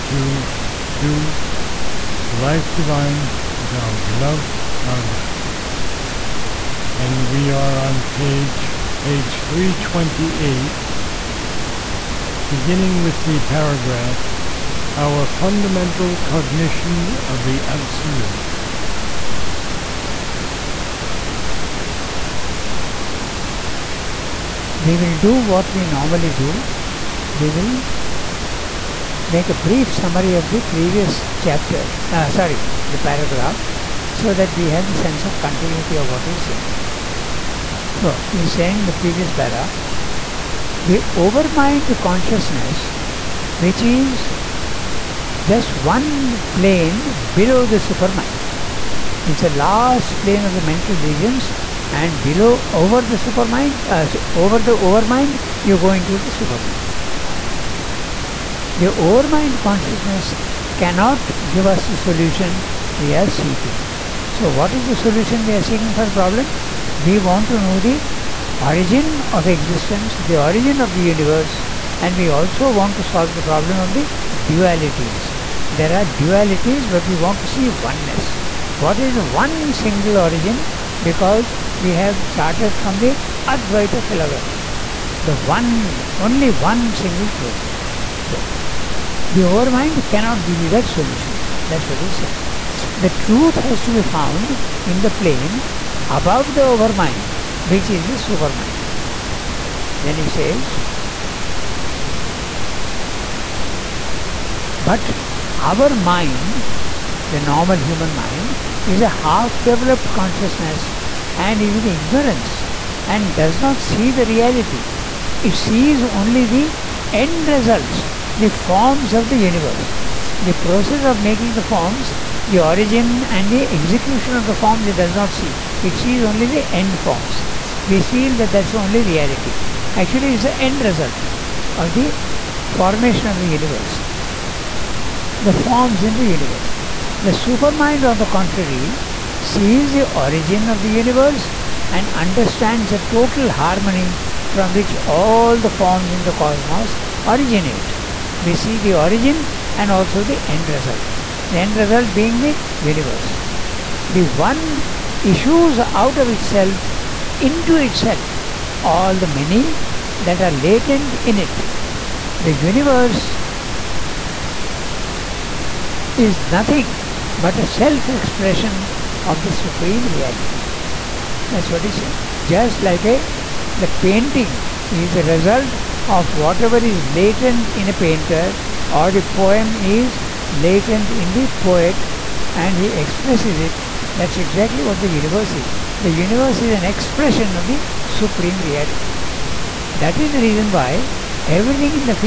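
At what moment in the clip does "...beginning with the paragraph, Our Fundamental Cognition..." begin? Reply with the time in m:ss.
0:12.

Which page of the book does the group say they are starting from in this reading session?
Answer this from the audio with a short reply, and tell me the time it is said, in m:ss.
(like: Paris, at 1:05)
328, at 0:08.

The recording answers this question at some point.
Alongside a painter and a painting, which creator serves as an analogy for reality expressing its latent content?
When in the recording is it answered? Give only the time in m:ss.
3:01.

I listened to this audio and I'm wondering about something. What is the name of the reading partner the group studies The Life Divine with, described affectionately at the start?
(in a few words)
Ranga.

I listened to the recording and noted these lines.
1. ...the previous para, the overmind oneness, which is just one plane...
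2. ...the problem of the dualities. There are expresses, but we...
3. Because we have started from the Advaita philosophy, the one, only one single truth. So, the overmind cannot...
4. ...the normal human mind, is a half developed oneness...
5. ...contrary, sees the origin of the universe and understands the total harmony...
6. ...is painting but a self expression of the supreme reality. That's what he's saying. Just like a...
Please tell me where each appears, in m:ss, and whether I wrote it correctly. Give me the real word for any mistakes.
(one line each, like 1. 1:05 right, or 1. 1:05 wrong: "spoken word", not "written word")
1. 0:38 wrong: "consciousness", not "oneness"
2. 1:13 wrong: "dualities", not "expresses"
3. 1:21 right
4. 1:47 wrong: "consciousness", not "oneness"
5. 2:18 right
6. 2:46 wrong: "nothing", not "painting".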